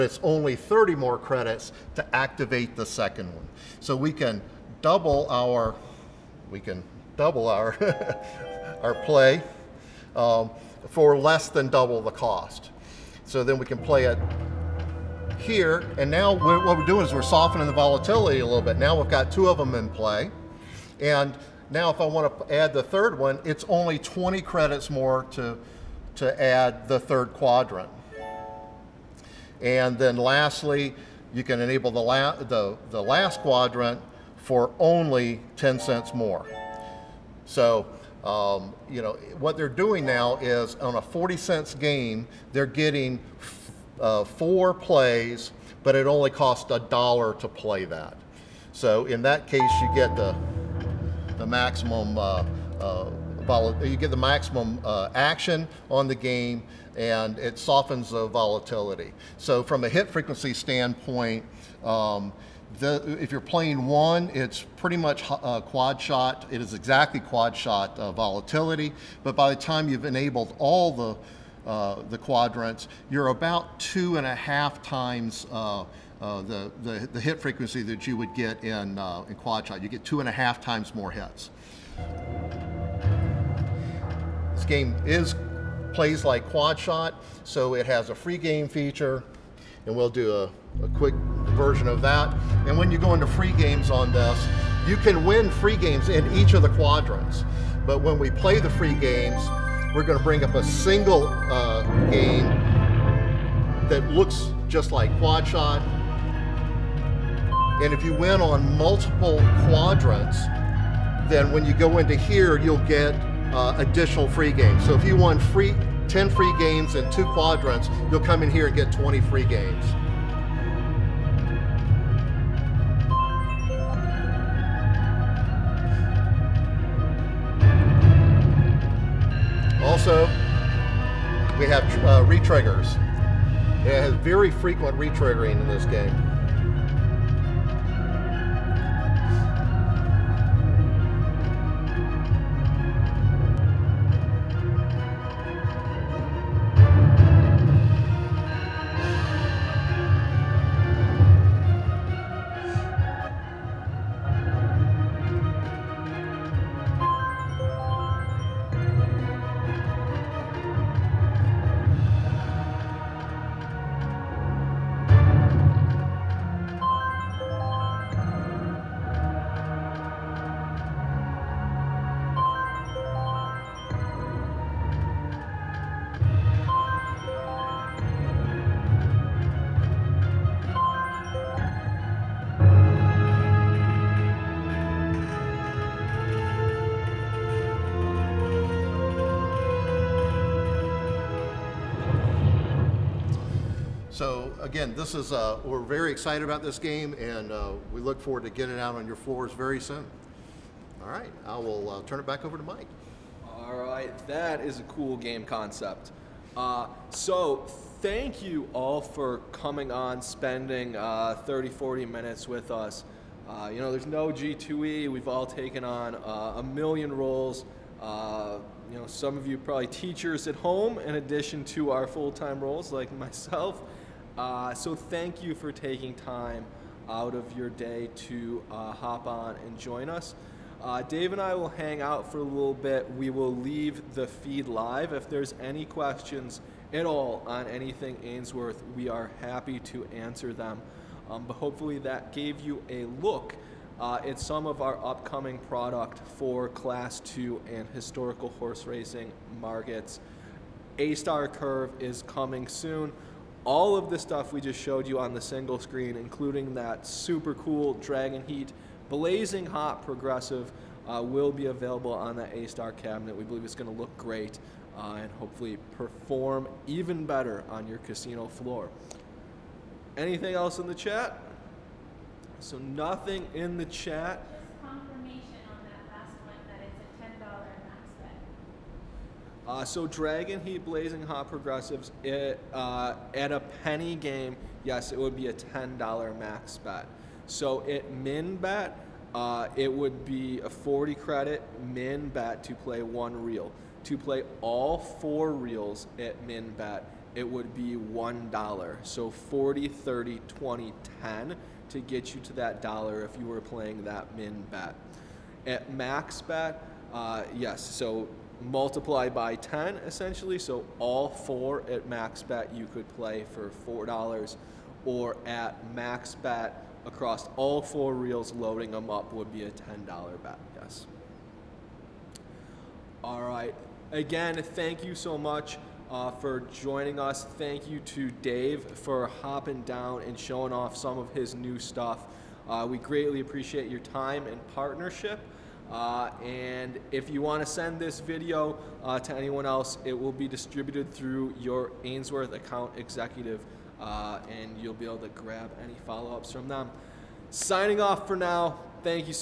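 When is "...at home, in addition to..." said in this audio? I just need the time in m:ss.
3:40.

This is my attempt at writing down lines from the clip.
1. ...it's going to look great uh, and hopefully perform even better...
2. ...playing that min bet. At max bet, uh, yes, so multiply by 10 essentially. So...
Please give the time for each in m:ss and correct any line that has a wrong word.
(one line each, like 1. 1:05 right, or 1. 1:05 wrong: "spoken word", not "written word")
1. 4:23 right
2. 5:03 right.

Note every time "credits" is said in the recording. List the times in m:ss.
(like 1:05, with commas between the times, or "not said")
0:01, 0:24, 4:51.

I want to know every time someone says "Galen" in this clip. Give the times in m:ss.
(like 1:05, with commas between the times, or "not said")
not said.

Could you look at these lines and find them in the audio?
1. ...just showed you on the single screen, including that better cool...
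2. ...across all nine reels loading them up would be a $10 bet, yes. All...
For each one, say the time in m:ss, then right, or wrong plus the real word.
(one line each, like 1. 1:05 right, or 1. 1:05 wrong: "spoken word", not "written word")
1. 4:14 wrong: "super", not "better"
2. 5:17 wrong: "four", not "nine".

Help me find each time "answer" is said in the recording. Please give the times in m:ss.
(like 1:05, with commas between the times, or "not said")
4:00.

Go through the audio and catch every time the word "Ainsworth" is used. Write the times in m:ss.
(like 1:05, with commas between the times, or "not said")
3:58, 5:42.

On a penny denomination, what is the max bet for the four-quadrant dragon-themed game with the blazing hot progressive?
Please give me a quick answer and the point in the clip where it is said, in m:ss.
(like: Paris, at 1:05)
$10, at 4:45.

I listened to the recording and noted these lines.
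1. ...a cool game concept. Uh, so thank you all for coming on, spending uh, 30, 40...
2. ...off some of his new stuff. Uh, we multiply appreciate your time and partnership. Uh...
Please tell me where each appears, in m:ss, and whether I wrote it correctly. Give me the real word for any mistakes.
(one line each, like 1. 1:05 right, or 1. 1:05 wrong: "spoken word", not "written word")
1. 3:24 right
2. 5:30 wrong: "greatly", not "multiply".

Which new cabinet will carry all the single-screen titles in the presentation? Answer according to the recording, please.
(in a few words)
A-Star Curve.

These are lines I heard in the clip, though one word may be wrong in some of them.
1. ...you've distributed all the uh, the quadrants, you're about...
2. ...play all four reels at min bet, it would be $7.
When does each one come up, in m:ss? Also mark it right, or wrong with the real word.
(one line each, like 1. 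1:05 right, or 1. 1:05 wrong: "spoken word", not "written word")
1. 1:09 wrong: "enabled", not "distributed"
2. 4:54 wrong: "1", not "7".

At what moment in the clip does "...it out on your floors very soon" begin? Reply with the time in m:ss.
3:18.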